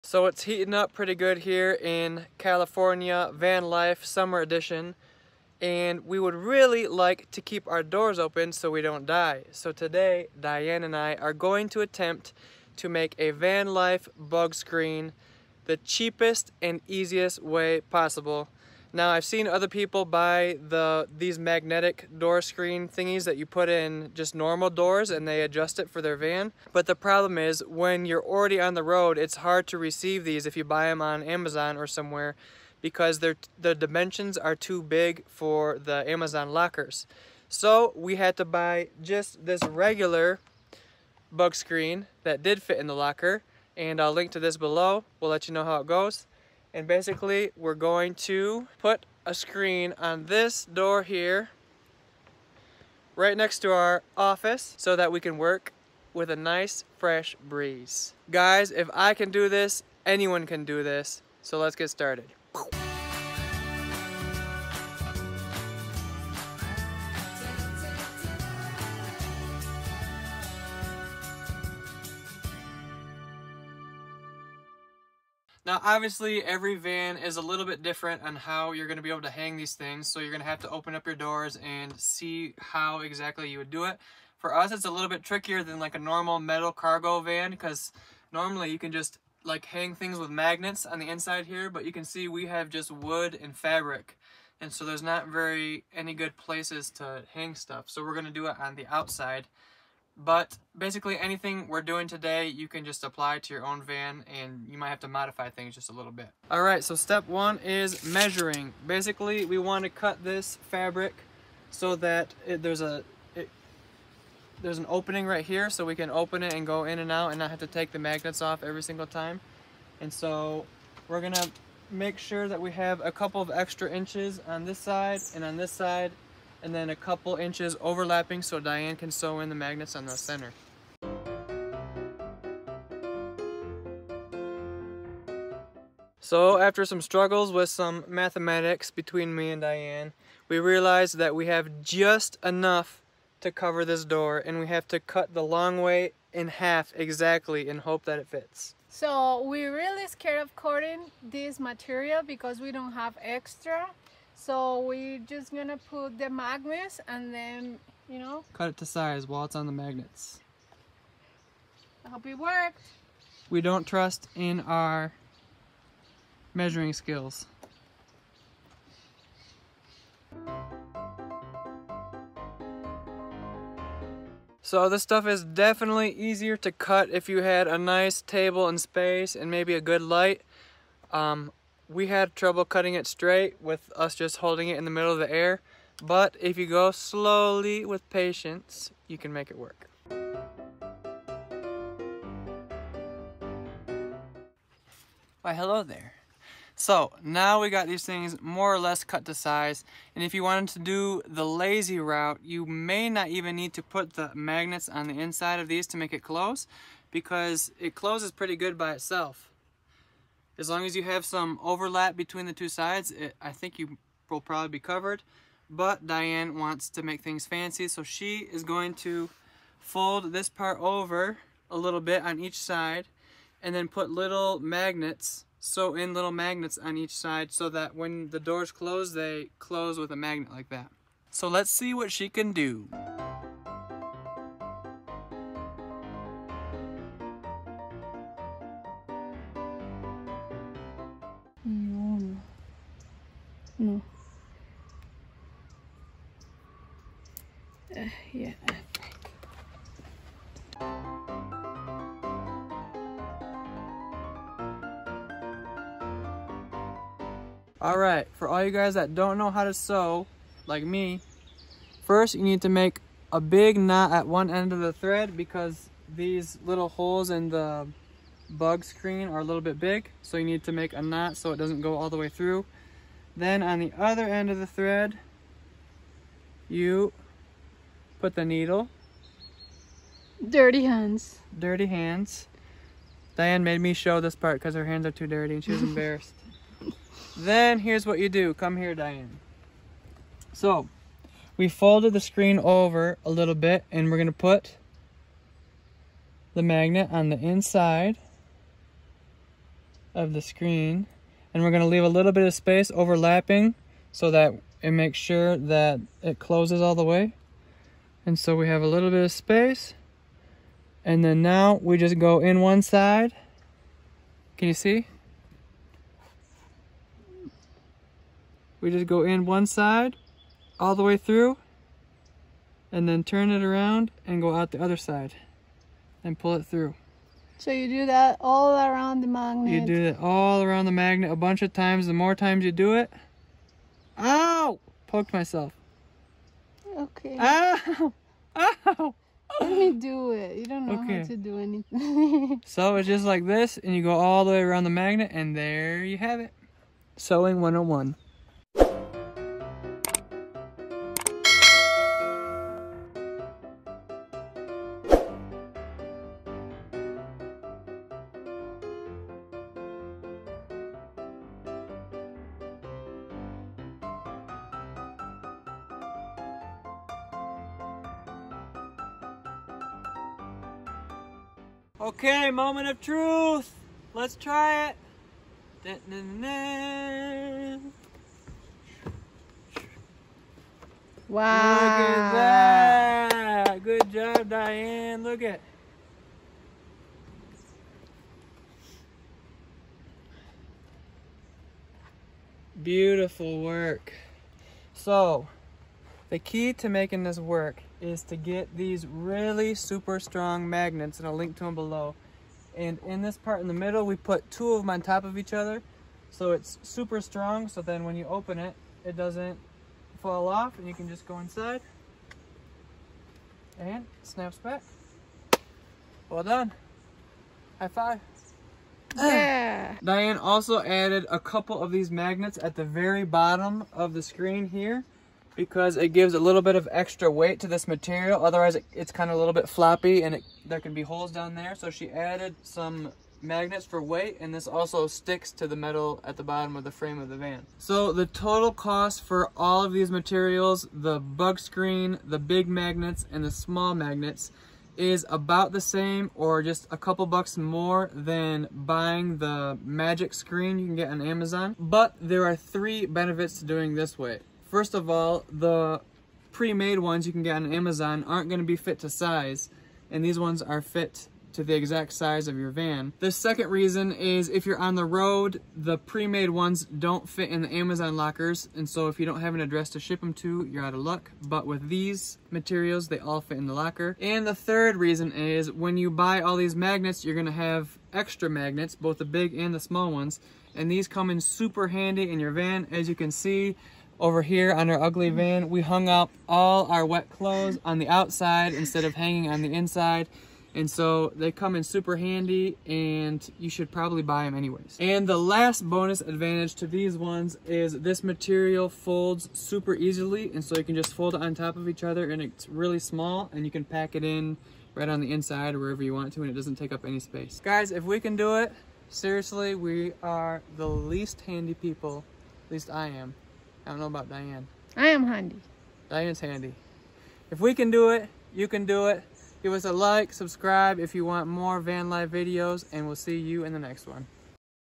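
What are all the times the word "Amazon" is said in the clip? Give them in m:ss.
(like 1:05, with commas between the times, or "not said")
0:31, 0:36, 7:31, 7:37, 7:47.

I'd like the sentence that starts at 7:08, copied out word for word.
Otherwise, it, it's kind of a little bit floppy and it, there can be holes down there.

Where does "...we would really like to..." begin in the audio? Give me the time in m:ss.
0:06.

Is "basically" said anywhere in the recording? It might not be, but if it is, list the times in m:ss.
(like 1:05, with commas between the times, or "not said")
0:46, 1:40, 1:48.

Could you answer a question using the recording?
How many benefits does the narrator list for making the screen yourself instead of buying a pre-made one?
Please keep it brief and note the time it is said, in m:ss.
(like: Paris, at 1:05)
3, at 7:32.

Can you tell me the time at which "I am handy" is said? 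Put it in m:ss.
8:34.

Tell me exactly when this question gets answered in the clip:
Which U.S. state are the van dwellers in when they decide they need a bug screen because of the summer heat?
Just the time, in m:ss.
0:02.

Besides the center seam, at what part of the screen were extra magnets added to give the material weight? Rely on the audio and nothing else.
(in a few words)
the very bottom.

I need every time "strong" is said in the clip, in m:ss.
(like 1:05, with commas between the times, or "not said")
6:40, 6:47.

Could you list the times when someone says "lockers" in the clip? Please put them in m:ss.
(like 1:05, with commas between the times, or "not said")
0:36, 0:42, 7:48, 7:53.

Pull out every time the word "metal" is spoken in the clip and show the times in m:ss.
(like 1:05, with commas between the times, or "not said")
1:26, 7:15.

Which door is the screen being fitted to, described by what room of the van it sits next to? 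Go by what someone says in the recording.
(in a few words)
office.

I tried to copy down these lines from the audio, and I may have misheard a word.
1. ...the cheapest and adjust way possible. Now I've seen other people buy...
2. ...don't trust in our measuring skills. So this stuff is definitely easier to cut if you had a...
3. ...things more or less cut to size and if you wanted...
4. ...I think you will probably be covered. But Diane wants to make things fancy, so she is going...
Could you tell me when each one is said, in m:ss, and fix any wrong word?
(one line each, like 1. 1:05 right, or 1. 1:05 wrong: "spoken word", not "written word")
1. 0:15 wrong: "easiest", not "adjust"
2. 2:43 right
3. 3:18 right
4. 3:33 right.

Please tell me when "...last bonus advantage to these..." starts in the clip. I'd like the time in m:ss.
8:15.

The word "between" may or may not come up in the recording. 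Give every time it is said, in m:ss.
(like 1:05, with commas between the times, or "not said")
2:18, 3:32.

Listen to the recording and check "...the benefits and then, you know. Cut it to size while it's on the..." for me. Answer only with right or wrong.
wrong.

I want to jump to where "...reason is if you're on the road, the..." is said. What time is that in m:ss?
7:43.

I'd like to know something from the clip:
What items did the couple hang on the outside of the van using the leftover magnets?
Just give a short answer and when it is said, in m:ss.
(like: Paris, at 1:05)
wet clothes, at 8:07.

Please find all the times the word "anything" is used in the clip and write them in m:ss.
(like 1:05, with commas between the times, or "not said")
1:41, 5:41.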